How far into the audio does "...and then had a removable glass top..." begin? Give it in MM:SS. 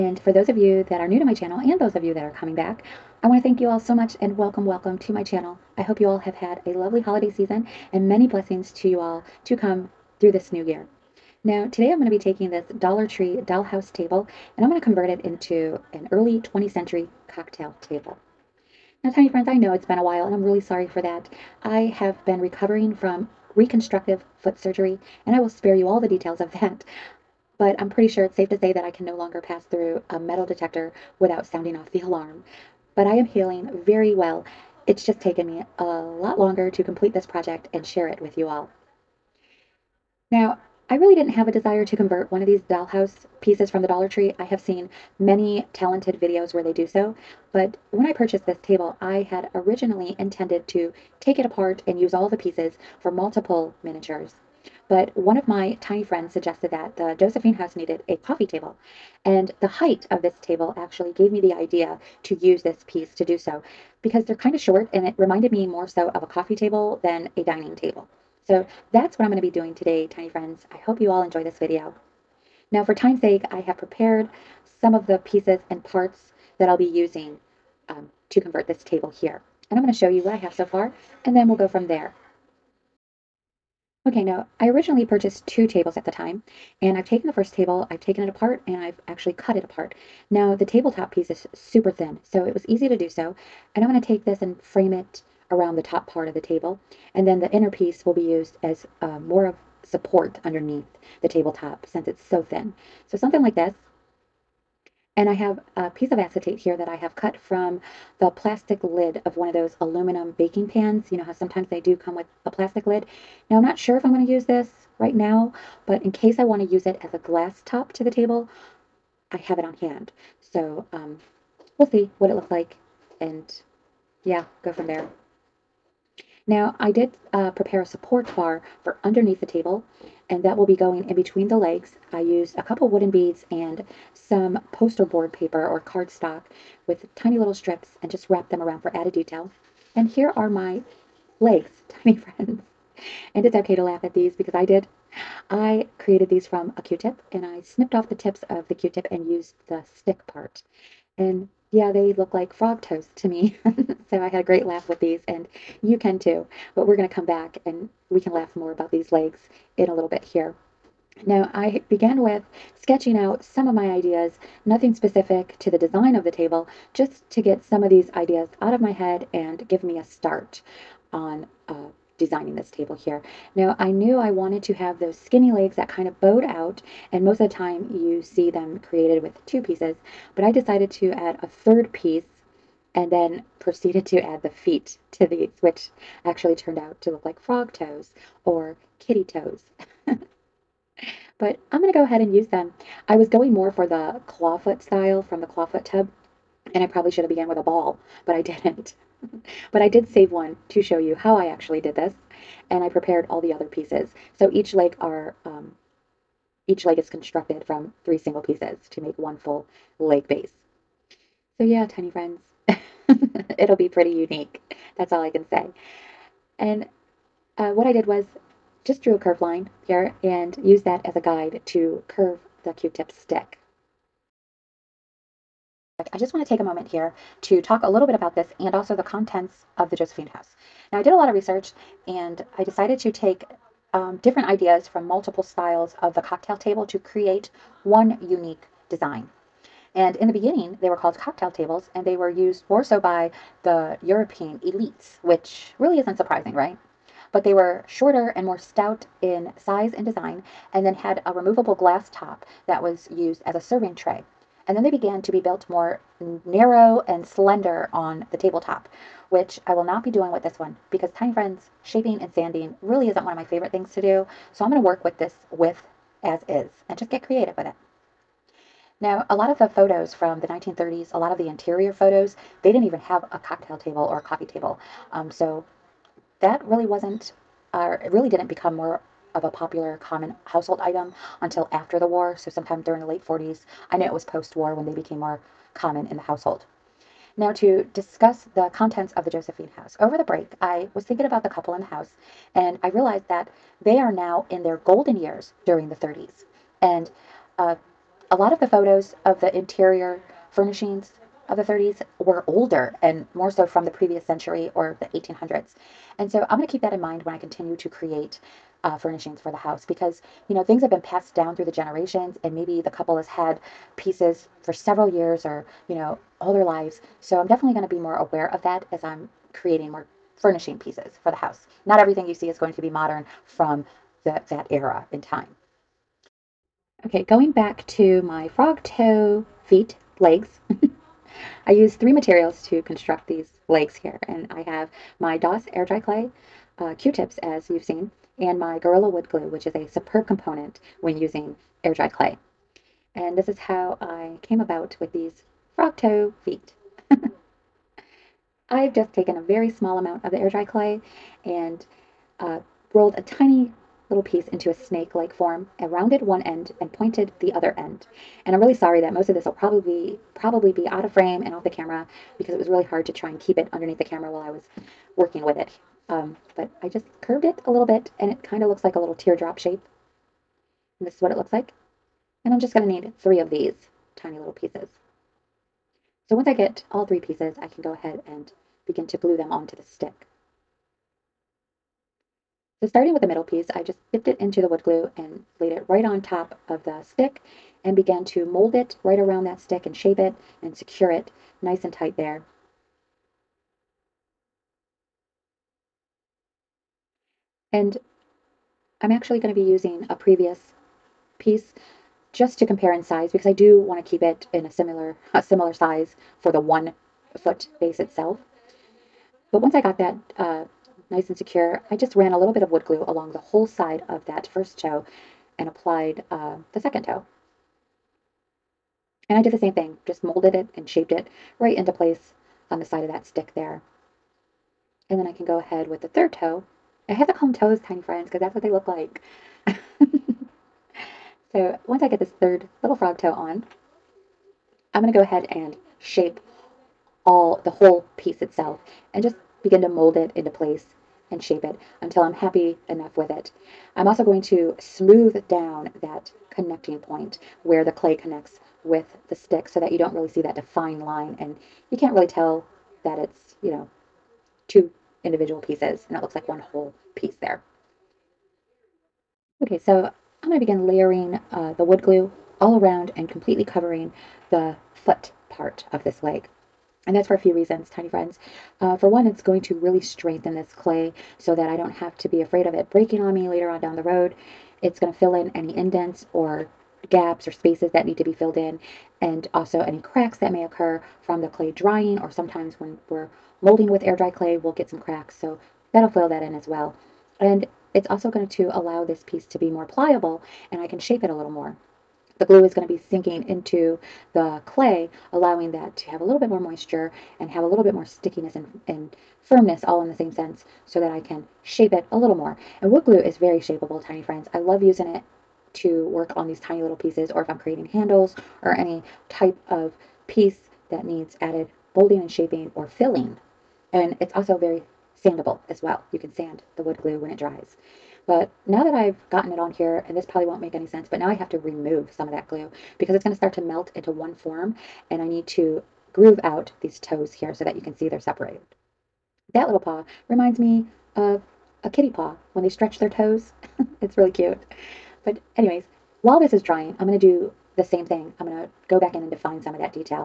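04:10.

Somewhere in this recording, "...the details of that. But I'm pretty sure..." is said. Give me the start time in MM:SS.
00:25.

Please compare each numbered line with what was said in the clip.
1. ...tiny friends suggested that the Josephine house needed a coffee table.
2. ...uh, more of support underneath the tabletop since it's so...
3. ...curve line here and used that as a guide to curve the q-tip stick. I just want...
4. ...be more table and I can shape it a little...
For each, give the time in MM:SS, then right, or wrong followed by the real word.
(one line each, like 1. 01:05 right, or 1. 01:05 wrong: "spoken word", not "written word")
1. 00:55 right
2. 01:39 right
3. 03:39 right
4. 08:09 wrong: "pliable", not "table".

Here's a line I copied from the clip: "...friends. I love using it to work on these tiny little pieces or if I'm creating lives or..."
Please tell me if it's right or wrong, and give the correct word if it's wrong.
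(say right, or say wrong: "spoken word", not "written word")
wrong: "handles", not "lives".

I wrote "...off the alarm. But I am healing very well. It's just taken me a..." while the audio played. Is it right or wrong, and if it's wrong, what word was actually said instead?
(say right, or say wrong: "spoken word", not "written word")
right.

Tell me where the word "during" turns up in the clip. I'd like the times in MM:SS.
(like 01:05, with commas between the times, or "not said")
04:42, 04:55.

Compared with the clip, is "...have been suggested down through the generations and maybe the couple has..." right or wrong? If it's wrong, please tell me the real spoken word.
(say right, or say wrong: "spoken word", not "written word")
wrong: "passed", not "suggested".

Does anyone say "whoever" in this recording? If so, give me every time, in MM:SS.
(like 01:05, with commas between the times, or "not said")
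not said.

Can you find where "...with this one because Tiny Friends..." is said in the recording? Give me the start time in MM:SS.
04:20.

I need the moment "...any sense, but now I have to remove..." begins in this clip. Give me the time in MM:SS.
08:40.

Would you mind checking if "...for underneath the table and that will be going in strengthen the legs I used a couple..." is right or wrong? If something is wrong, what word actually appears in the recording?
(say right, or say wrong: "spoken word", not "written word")
wrong: "between", not "strengthen".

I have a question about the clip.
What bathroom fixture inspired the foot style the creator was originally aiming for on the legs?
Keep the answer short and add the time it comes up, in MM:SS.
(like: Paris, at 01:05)
clawfoot tub, at 03:15.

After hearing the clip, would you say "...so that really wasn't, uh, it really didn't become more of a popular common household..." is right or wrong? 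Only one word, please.
right.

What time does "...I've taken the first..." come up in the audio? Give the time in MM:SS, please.
01:26.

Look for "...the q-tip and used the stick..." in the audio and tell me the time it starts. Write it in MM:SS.
02:28.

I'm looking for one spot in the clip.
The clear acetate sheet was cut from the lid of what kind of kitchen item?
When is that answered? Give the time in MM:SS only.
01:49.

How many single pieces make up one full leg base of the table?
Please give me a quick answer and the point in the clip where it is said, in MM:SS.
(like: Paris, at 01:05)
3, at 03:28.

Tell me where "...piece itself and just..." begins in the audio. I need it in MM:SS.
07:18.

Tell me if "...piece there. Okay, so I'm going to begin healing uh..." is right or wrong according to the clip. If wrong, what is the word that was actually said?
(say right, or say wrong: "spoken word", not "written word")
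wrong: "layering", not "healing".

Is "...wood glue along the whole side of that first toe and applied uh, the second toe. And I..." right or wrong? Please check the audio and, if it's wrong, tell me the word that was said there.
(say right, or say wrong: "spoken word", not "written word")
right.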